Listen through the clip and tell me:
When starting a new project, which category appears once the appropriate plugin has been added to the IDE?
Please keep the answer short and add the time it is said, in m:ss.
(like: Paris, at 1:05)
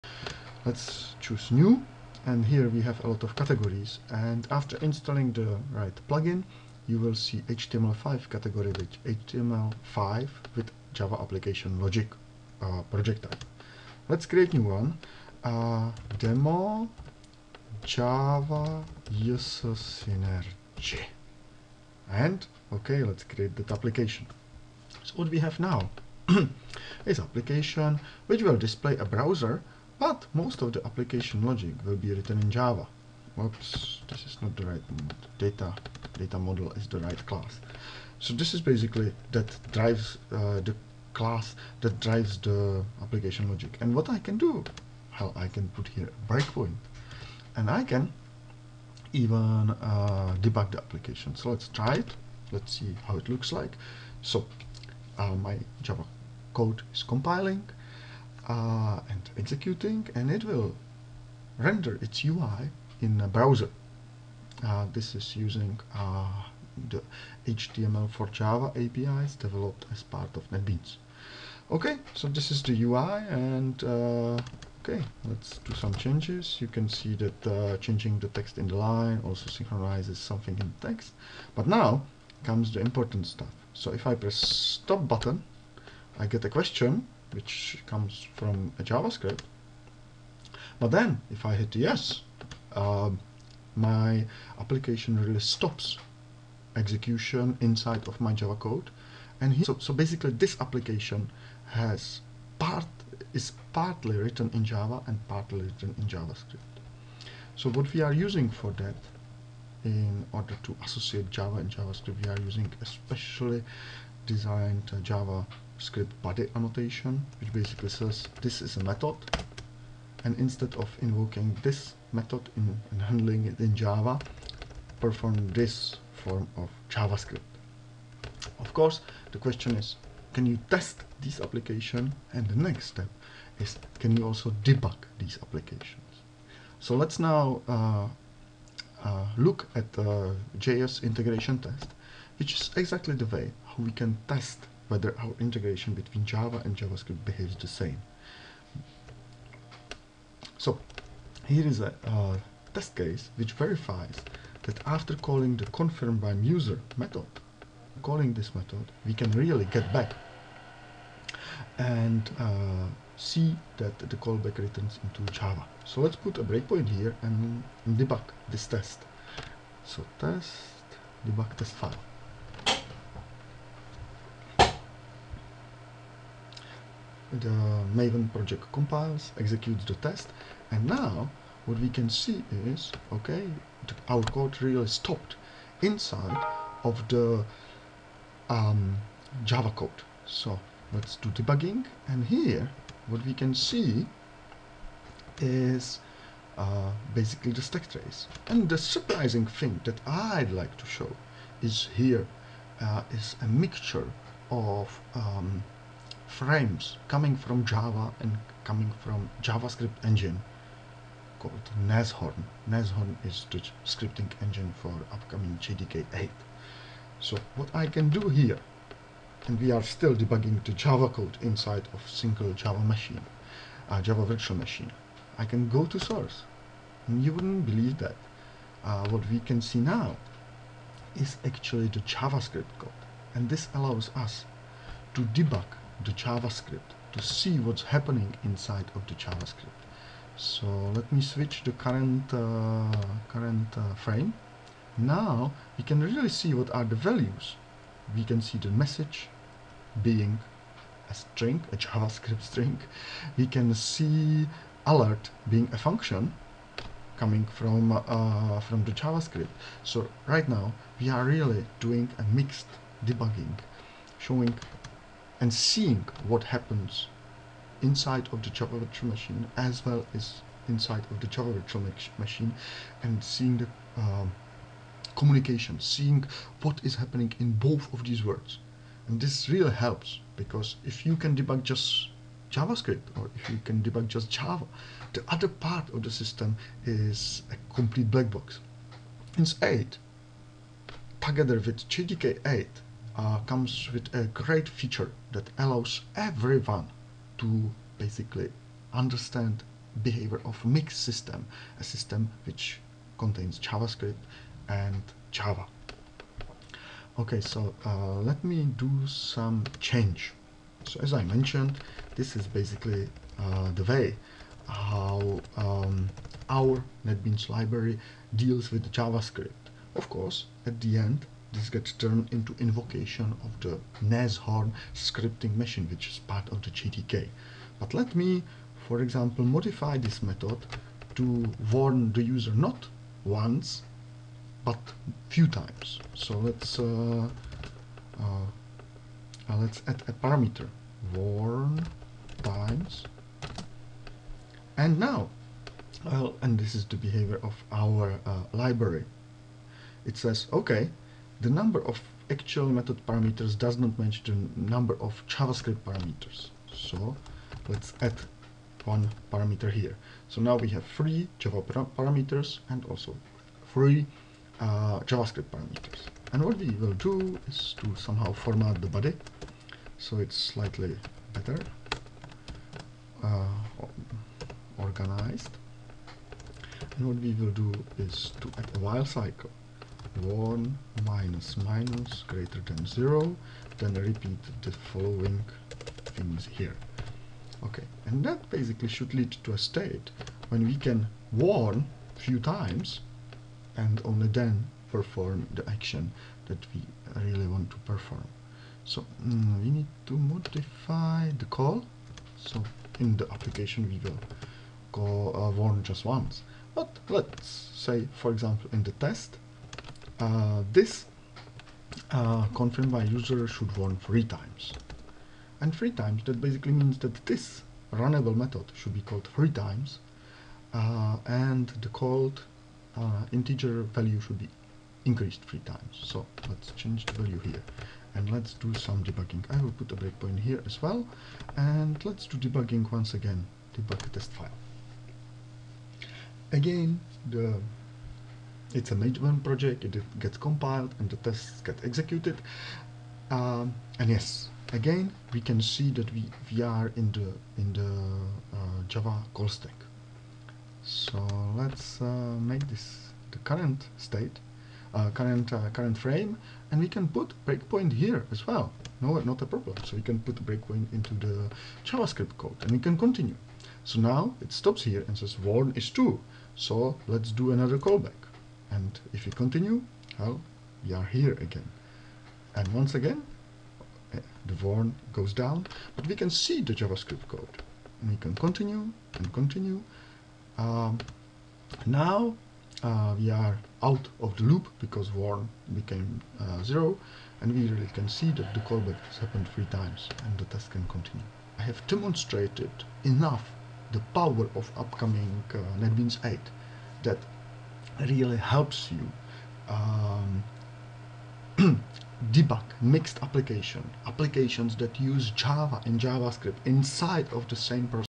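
HTML5, at 0:07.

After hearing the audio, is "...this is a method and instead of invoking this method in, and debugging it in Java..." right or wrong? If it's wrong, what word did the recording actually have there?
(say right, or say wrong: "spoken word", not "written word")
wrong: "handling", not "debugging".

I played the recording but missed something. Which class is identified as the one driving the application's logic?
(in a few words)
Data model.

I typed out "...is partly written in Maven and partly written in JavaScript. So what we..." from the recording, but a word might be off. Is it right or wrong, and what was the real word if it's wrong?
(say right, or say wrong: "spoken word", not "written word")
wrong: "Java", not "Maven".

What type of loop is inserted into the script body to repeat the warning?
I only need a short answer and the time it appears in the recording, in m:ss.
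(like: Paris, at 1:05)
while, at 6:18.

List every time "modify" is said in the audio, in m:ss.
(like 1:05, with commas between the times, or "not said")
5:29, 6:40.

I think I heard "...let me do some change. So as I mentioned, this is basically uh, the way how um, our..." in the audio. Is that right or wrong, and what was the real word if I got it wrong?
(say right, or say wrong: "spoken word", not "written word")
right.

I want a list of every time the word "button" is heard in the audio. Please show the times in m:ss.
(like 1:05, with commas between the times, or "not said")
1:25.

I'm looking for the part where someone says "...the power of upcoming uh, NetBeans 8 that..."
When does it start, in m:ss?
8:13.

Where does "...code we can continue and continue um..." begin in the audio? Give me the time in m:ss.
7:57.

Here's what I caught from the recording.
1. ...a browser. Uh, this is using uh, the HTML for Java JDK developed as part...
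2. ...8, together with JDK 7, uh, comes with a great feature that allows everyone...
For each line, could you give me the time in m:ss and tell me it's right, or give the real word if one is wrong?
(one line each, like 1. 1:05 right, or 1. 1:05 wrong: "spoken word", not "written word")
1. 1:03 wrong: "APIs", not "JDK"
2. 4:49 wrong: "8", not "7".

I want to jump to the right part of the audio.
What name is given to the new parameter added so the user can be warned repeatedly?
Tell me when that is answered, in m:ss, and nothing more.
5:41.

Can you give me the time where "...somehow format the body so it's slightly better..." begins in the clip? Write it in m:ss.
6:07.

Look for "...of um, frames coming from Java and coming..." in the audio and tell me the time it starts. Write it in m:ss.
3:24.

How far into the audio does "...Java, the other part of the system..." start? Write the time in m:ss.
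4:44.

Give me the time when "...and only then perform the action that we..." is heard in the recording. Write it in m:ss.
6:33.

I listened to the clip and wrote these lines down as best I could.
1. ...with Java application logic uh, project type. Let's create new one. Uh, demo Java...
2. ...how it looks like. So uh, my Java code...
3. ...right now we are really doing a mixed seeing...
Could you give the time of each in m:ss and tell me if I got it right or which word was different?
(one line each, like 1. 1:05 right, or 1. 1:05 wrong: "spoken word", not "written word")
1. 0:10 right
2. 0:53 right
3. 4:20 wrong: "debugging", not "seeing".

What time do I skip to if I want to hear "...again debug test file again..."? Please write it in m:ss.
7:13.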